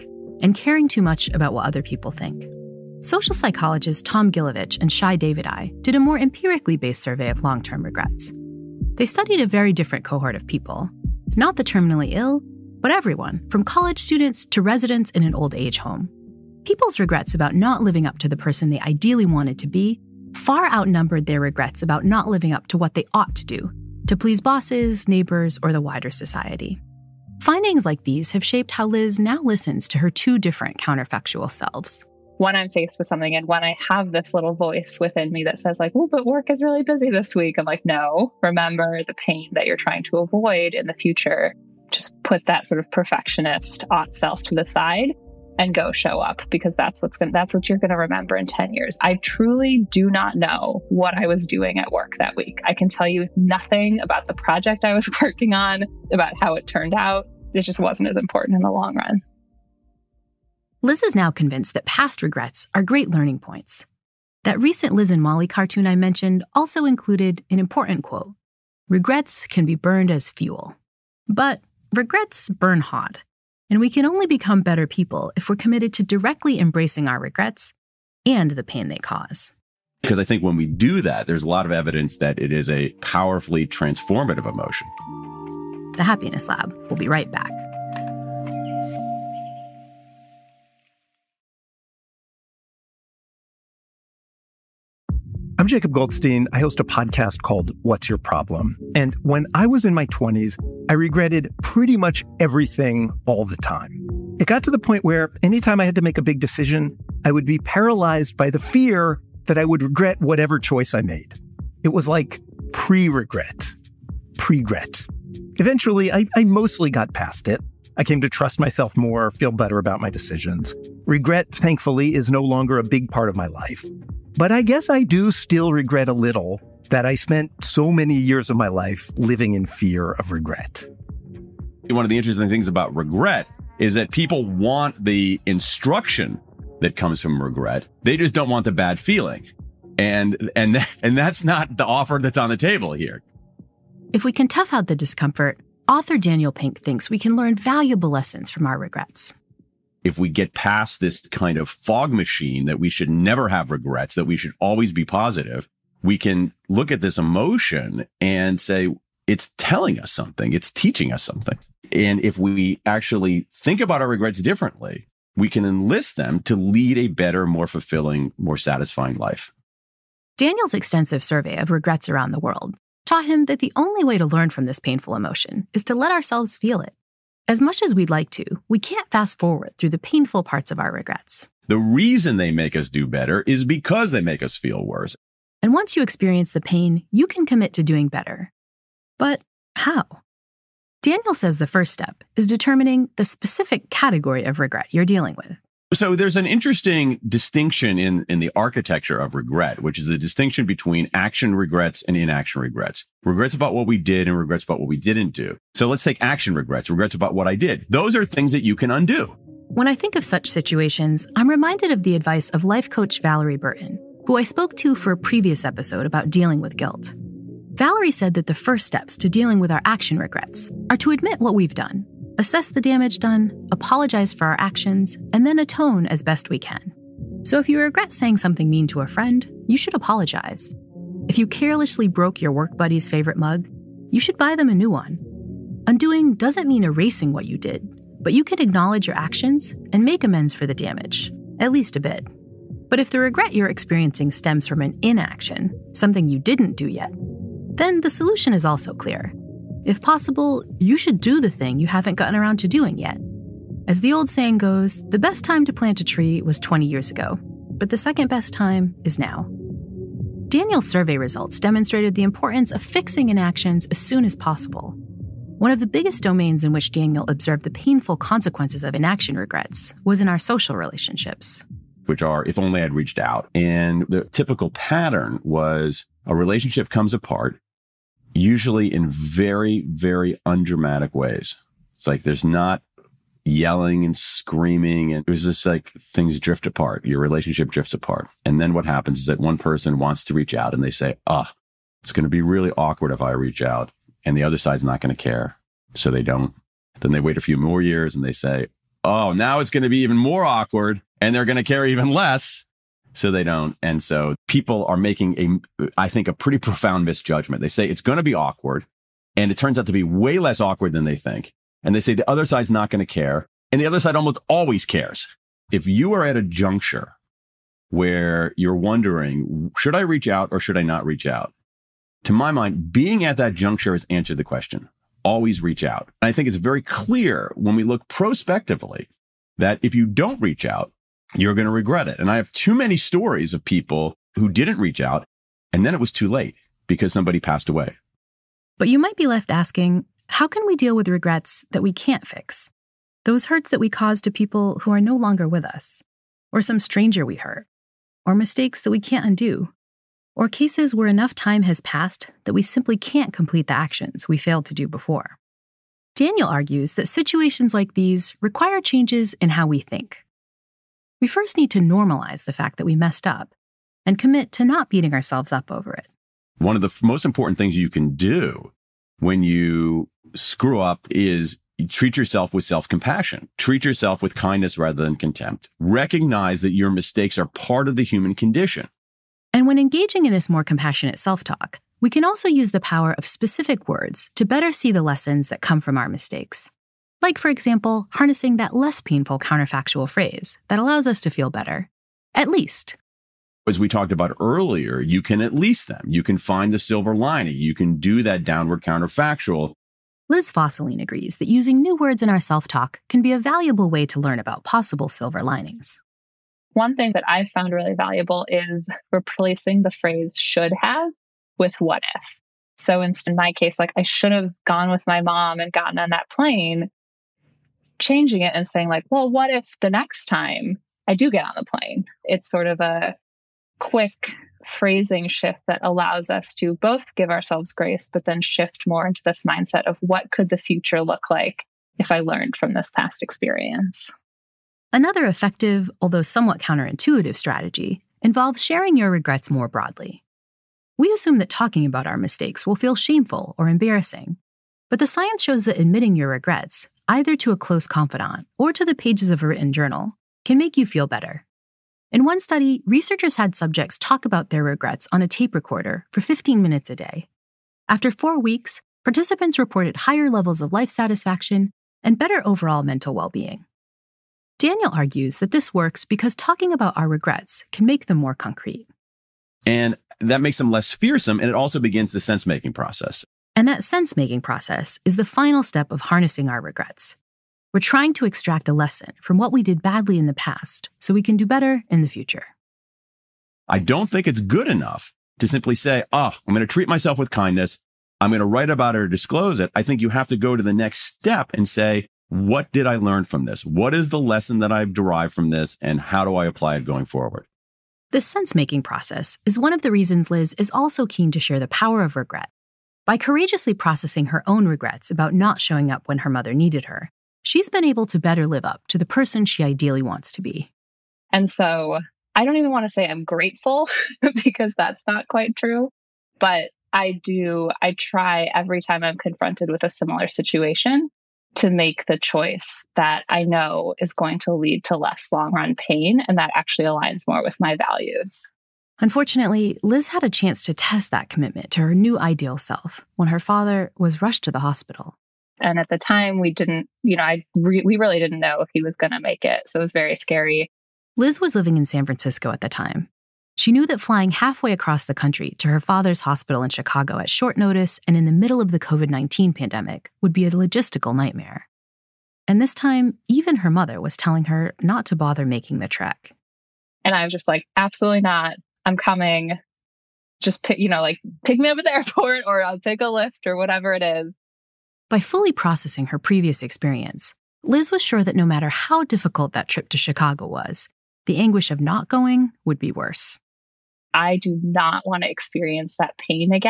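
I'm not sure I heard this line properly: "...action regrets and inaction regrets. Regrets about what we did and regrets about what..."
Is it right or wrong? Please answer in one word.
right.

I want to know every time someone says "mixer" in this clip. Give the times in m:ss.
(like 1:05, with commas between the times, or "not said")
not said.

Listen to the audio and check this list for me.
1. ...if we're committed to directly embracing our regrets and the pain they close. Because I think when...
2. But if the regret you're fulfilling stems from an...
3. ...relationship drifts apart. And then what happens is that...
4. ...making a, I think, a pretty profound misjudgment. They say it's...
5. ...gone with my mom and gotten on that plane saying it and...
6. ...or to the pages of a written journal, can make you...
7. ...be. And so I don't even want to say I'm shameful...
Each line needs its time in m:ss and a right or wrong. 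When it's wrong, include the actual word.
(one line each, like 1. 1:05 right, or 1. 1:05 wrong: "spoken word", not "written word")
1. 1:15 wrong: "cause", not "close"
2. 4:02 wrong: "experiencing", not "fulfilling"
3. 4:47 right
4. 5:04 right
5. 6:54 wrong: "changing", not "saying"
6. 7:28 right
7. 8:30 wrong: "grateful", not "shameful".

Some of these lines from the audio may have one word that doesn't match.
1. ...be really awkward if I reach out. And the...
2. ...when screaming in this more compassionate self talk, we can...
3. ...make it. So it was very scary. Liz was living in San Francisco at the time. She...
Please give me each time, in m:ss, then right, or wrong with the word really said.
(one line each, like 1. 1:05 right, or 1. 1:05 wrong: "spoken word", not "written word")
1. 4:52 right
2. 6:19 wrong: "engaging", not "screaming"
3. 8:59 right.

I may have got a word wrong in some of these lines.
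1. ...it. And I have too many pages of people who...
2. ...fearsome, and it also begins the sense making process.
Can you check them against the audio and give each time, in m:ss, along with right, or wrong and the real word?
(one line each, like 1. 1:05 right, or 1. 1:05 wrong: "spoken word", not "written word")
1. 5:32 wrong: "stories", not "pages"
2. 7:50 right.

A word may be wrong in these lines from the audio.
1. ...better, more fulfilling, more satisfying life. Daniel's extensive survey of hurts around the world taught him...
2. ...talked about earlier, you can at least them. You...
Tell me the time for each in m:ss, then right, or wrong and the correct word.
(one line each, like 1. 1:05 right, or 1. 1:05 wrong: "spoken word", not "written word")
1. 2:47 wrong: "regrets", not "hurts"
2. 6:33 right.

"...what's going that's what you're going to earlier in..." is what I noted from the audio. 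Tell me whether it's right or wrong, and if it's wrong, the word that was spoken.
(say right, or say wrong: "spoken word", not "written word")
wrong: "remember", not "earlier".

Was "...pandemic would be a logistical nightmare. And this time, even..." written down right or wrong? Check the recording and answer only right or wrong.
right.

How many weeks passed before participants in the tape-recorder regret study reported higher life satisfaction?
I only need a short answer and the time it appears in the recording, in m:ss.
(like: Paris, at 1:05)
4, at 7:38.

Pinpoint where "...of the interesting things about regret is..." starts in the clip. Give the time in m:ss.
2:12.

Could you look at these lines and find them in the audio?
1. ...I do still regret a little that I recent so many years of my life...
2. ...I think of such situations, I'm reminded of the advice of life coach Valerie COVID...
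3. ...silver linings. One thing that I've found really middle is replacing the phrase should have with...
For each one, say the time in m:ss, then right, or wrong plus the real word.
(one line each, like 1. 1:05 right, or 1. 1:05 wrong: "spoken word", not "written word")
1. 2:04 wrong: "spent", not "recent"
2. 3:29 wrong: "Burton", not "COVID"
3. 6:45 wrong: "valuable", not "middle".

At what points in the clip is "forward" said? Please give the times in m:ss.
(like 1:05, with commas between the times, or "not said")
2:59, 8:17.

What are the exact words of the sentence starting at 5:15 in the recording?
If you are at a juncture where you're wondering, should I reach out or should I not reach out?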